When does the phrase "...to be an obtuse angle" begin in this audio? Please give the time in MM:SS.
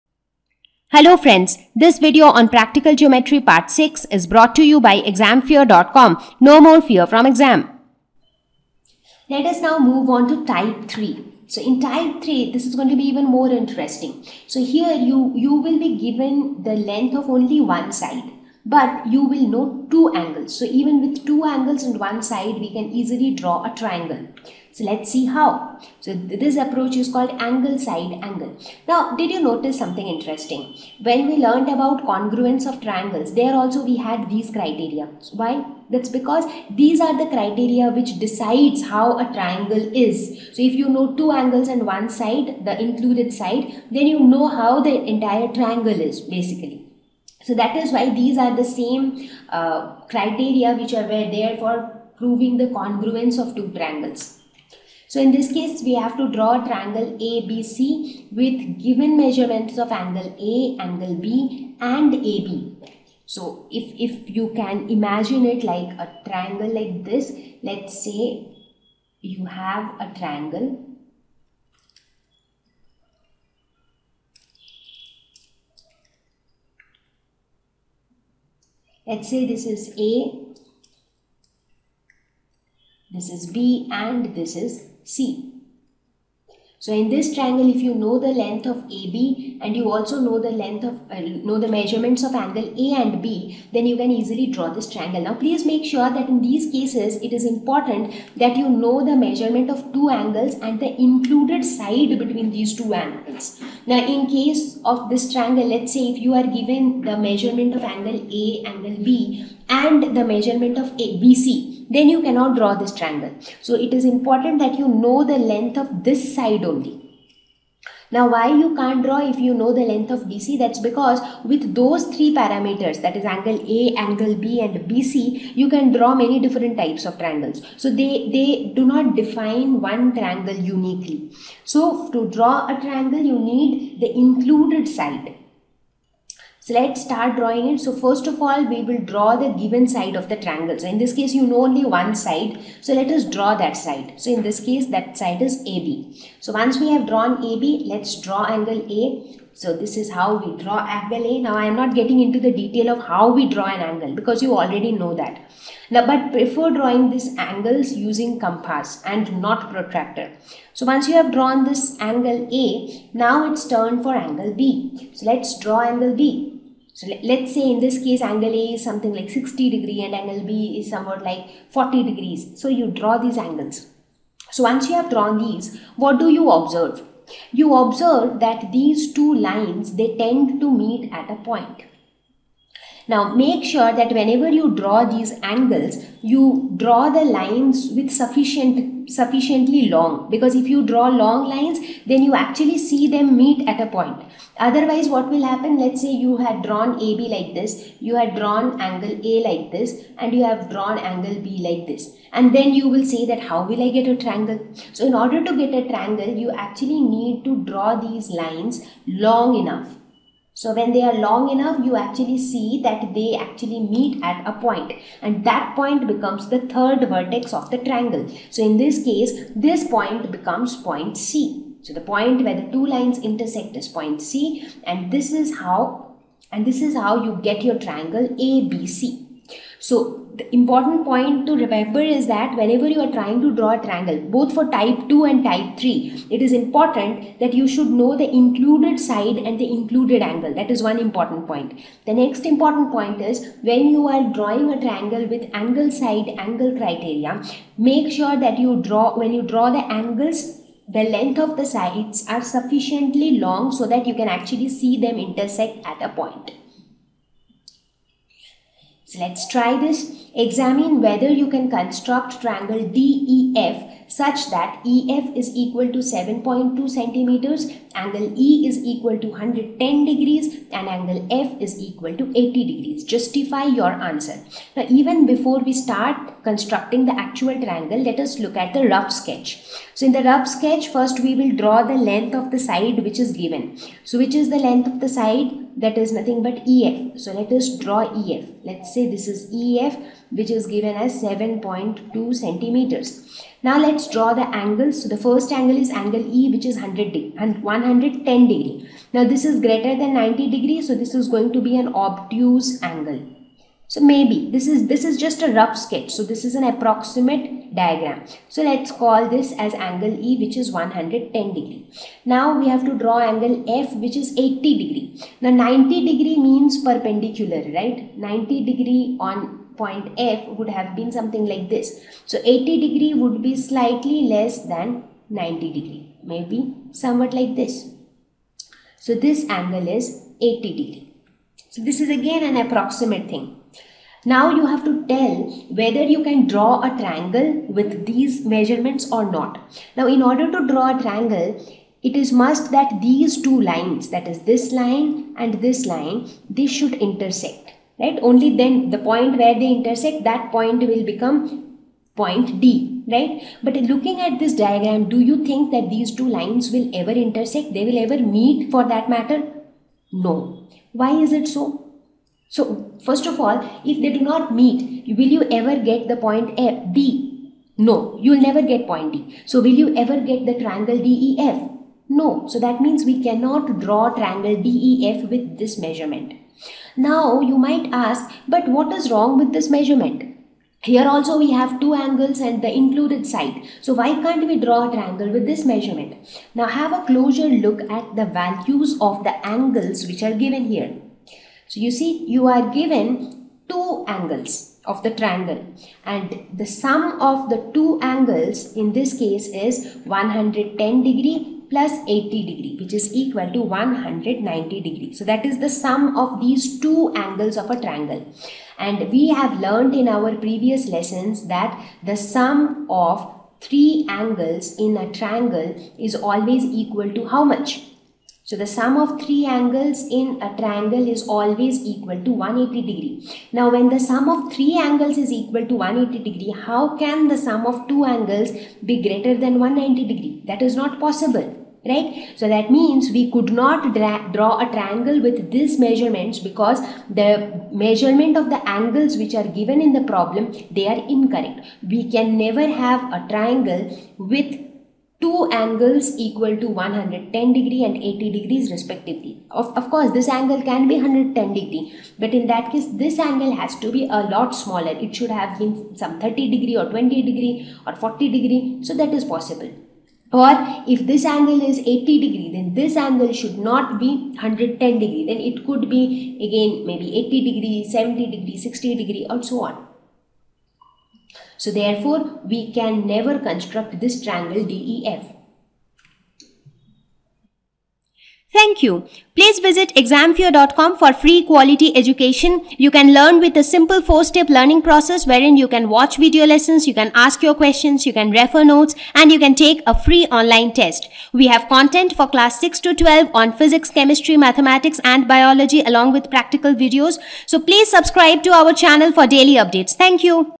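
05:01.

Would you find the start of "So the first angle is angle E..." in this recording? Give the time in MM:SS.
04:55.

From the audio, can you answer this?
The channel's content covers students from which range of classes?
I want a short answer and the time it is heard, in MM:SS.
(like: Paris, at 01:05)
class 6 to 12, at 08:12.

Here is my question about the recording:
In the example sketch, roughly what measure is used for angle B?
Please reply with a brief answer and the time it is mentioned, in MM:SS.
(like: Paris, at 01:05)
40 degrees, at 02:51.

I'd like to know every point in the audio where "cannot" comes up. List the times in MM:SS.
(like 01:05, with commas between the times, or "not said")
01:52, 06:13.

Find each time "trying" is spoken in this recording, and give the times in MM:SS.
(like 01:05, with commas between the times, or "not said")
03:53.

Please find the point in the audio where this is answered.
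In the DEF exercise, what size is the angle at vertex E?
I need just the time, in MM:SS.
04:29.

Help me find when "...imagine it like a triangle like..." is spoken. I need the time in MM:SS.
01:04.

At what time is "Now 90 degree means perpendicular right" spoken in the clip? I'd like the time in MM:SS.
05:15.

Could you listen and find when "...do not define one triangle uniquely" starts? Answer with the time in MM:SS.
02:08.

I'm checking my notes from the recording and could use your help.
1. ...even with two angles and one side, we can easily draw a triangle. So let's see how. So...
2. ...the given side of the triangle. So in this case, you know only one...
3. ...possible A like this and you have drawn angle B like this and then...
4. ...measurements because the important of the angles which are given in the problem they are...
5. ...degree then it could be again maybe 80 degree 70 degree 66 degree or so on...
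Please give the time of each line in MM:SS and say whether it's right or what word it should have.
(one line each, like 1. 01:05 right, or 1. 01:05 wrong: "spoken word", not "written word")
1. 00:20 right
2. 02:19 right
3. 03:18 wrong: "angle", not "possible"
4. 07:15 wrong: "measurement", not "important"
5. 07:44 wrong: "60", not "66".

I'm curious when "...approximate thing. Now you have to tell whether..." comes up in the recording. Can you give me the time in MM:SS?
05:32.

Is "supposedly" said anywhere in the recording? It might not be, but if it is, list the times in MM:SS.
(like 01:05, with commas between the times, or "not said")
not said.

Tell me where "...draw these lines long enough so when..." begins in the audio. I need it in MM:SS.
03:27.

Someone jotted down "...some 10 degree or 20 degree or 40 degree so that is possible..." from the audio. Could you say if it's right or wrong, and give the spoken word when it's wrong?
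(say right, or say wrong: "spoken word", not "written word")
wrong: "30", not "10".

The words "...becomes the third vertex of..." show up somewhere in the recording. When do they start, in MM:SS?
03:36.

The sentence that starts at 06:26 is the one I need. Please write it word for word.
Now have a closer look at the values of the angles which are given here.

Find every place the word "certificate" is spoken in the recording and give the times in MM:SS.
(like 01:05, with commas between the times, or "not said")
not said.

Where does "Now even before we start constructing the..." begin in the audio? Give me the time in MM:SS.
04:34.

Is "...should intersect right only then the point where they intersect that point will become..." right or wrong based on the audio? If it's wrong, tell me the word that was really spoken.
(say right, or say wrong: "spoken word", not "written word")
right.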